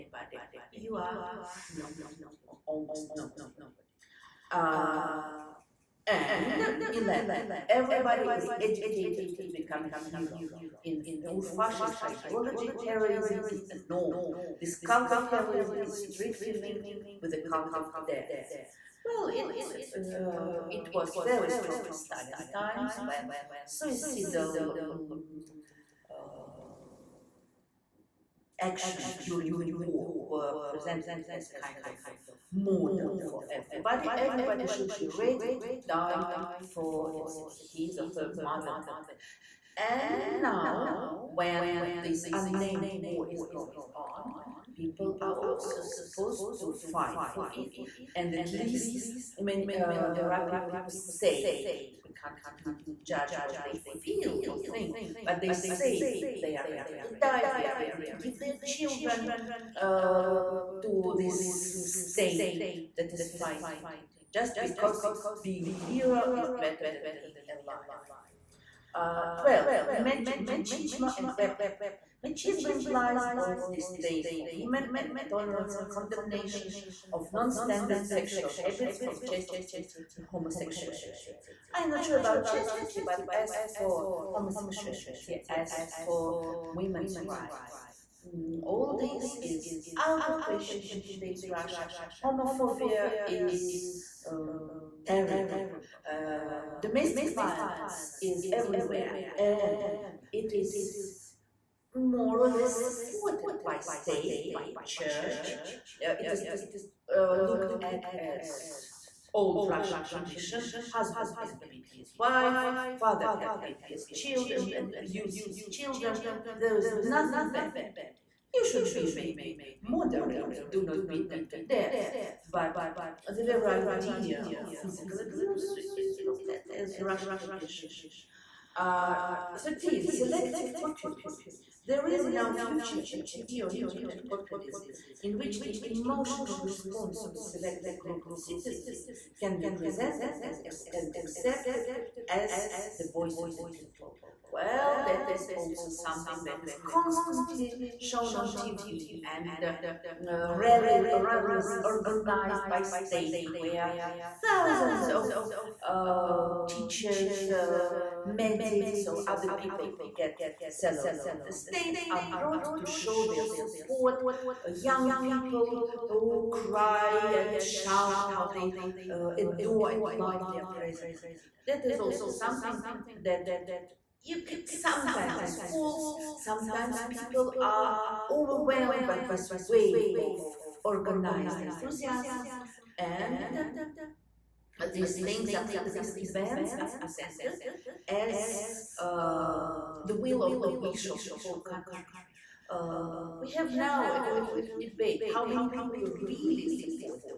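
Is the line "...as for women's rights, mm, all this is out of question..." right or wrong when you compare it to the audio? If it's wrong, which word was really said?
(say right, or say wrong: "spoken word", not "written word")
right.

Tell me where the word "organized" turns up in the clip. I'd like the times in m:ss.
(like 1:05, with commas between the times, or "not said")
2:31, 3:00.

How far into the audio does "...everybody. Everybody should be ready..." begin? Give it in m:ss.
0:33.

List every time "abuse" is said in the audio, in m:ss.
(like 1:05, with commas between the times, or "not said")
1:54, 2:05.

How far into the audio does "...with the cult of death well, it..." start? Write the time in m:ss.
0:17.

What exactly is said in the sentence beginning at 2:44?
Uh, young people who cry and shout how they uh, adore and love their president.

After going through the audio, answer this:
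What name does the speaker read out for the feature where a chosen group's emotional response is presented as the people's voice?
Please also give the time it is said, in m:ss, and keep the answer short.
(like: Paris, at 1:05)
Selective populism, at 2:10.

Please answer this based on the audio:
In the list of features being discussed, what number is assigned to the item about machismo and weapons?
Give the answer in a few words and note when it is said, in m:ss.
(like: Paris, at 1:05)
12, at 1:09.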